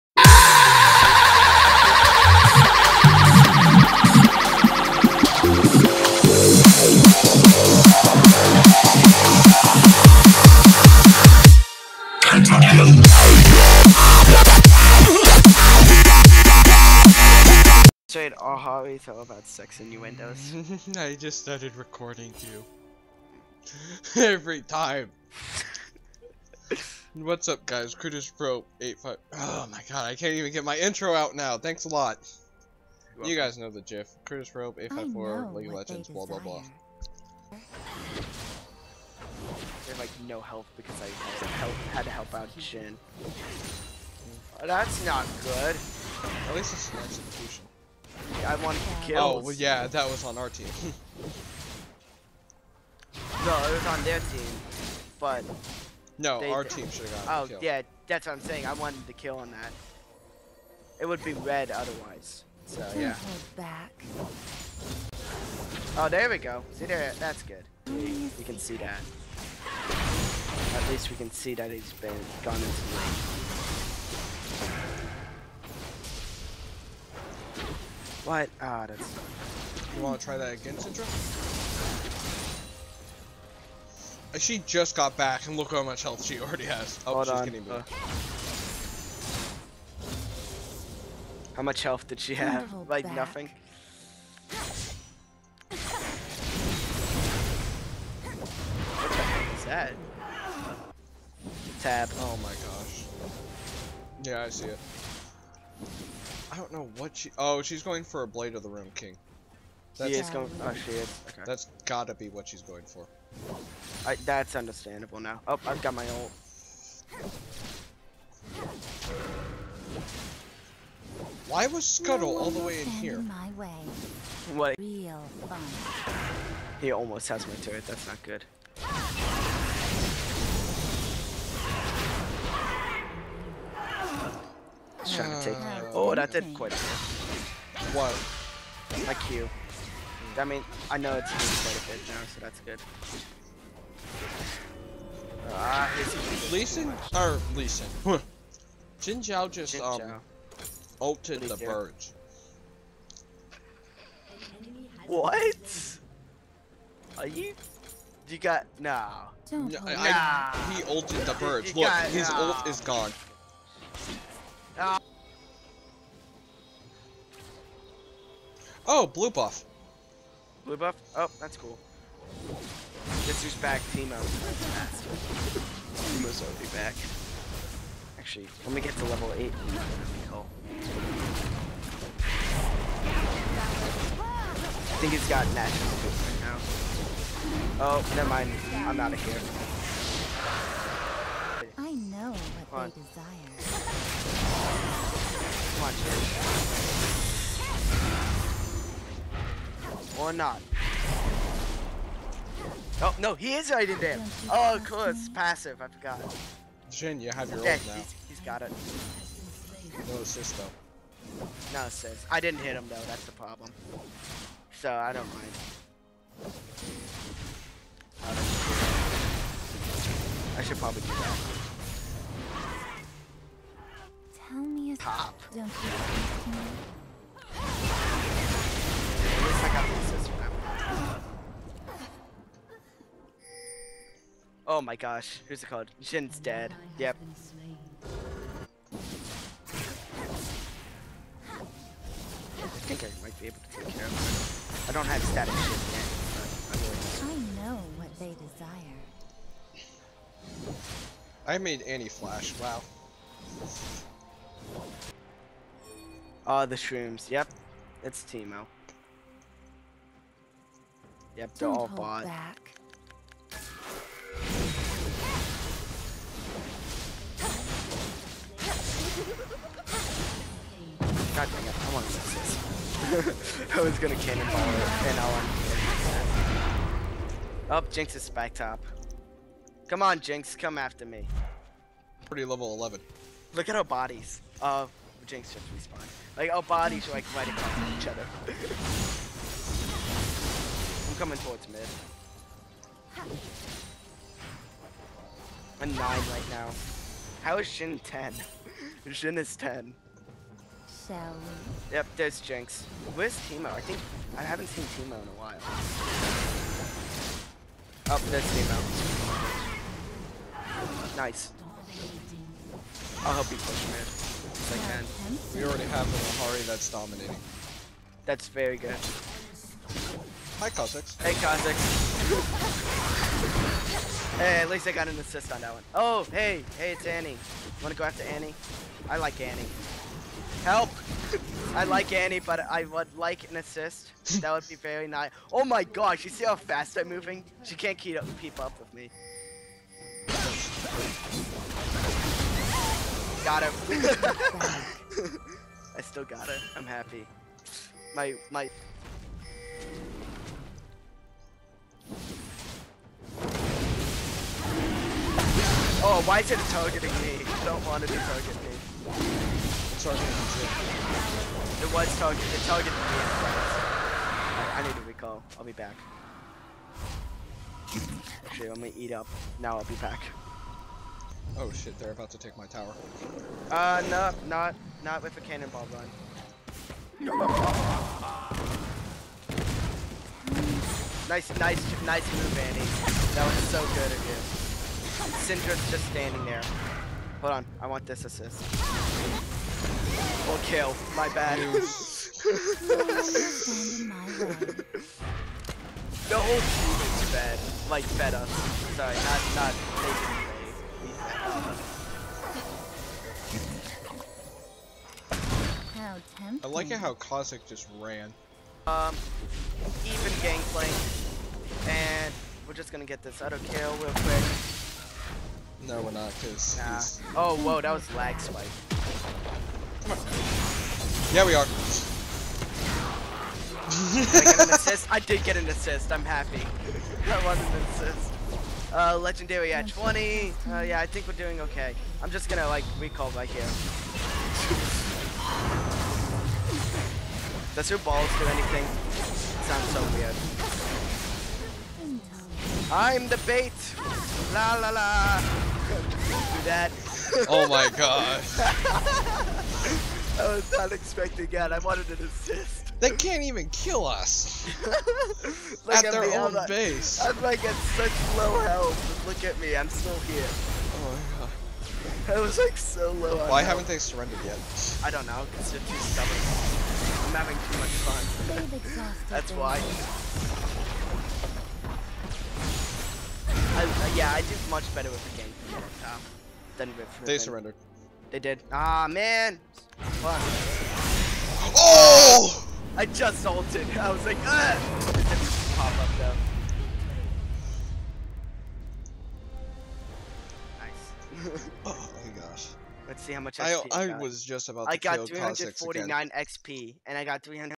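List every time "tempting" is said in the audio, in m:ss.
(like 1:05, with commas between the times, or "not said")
6:46.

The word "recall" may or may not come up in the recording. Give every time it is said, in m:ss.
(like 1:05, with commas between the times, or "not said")
6:05, 7:12.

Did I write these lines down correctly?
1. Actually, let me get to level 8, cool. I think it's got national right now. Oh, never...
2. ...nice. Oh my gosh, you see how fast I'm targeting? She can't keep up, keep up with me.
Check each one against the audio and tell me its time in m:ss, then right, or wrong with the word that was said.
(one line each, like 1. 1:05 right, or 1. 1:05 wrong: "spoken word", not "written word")
1. 2:58 right
2. 5:35 wrong: "moving", not "targeting".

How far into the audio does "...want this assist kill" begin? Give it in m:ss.
6:27.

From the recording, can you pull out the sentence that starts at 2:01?
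Why was Scuttle no all the way in here?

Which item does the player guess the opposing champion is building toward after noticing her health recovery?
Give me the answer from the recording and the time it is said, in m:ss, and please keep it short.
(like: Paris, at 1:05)
Blade of the Ruined King, at 1:48.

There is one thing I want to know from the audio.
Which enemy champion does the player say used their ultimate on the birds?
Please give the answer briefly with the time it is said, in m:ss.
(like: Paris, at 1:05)
Xin Zhao, at 2:29.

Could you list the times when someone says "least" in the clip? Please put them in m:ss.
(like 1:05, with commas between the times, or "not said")
0:46, 1:10, 5:24.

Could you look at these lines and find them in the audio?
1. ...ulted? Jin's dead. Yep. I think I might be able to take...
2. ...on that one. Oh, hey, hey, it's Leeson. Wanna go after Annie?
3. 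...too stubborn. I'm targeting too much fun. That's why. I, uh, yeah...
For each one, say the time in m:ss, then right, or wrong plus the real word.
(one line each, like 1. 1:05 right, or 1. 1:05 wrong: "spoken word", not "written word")
1. 3:55 wrong: "called", not "ulted"
2. 5:25 wrong: "Annie", not "Leeson"
3. 7:45 wrong: "having", not "targeting".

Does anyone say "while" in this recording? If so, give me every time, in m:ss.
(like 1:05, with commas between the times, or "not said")
5:05.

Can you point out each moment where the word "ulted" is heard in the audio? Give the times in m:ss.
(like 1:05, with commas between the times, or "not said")
2:31, 2:40, 8:03.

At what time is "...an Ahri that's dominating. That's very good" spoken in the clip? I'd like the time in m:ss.
5:16.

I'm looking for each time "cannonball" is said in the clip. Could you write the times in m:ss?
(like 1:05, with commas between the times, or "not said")
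4:34, 6:15.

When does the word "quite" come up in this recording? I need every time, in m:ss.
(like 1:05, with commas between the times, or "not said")
2:16, 2:21.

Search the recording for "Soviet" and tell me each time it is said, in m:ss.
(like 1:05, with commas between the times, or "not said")
not said.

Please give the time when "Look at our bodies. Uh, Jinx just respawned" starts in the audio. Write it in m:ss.
4:43.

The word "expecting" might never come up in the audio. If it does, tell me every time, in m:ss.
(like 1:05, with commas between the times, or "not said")
7:30.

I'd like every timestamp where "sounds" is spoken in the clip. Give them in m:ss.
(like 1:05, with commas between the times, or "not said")
7:19.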